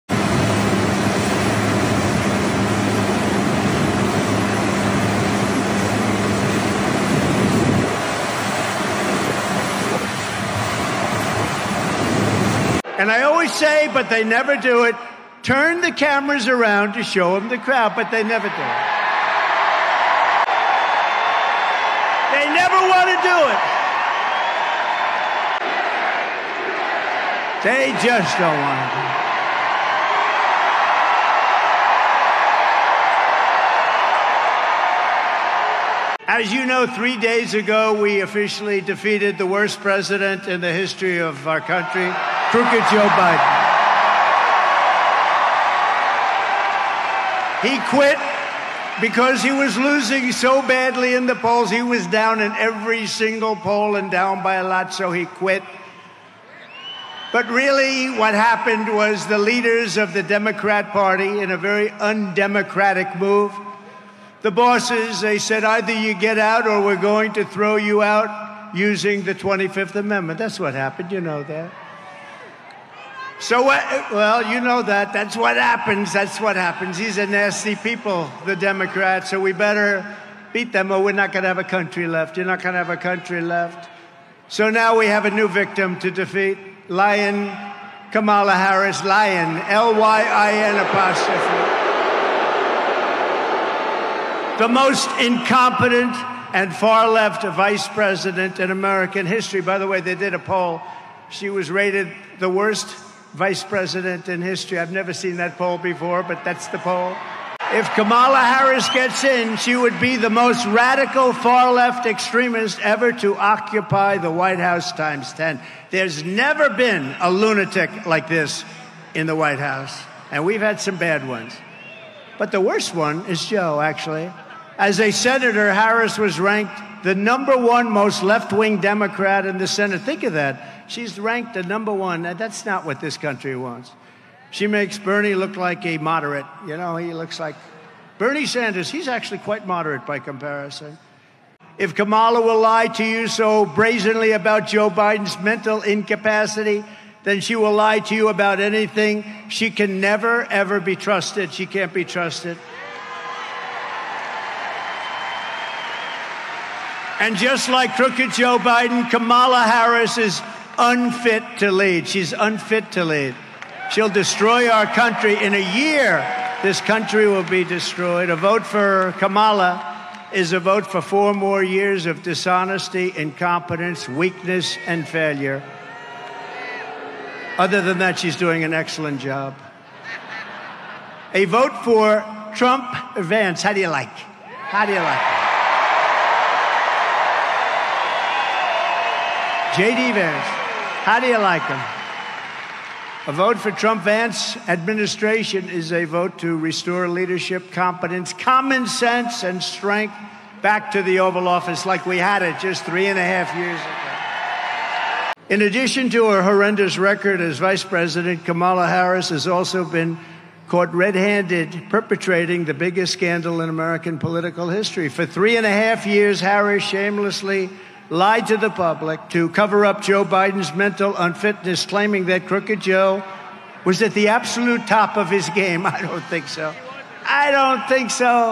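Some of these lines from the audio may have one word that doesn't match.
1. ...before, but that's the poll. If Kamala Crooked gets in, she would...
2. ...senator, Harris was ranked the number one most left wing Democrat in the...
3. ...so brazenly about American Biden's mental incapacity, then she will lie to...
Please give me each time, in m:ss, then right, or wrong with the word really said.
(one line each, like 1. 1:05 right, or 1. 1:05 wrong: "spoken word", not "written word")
1. 1:45 wrong: "Harris", not "Crooked"
2. 2:05 right
3. 2:23 wrong: "Joe", not "American".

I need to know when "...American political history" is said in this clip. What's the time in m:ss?
3:33.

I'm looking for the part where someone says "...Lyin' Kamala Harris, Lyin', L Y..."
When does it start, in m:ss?
1:26.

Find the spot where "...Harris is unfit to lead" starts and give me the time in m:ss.
2:39.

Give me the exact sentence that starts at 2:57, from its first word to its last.
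Other than that, she's doing an excellent job.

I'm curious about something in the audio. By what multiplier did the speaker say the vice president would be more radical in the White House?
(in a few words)
times 10.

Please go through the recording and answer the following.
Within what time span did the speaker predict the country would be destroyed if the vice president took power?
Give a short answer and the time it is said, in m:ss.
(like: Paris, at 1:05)
1 year, at 2:45.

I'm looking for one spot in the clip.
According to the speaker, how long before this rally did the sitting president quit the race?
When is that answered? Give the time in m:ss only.
0:36.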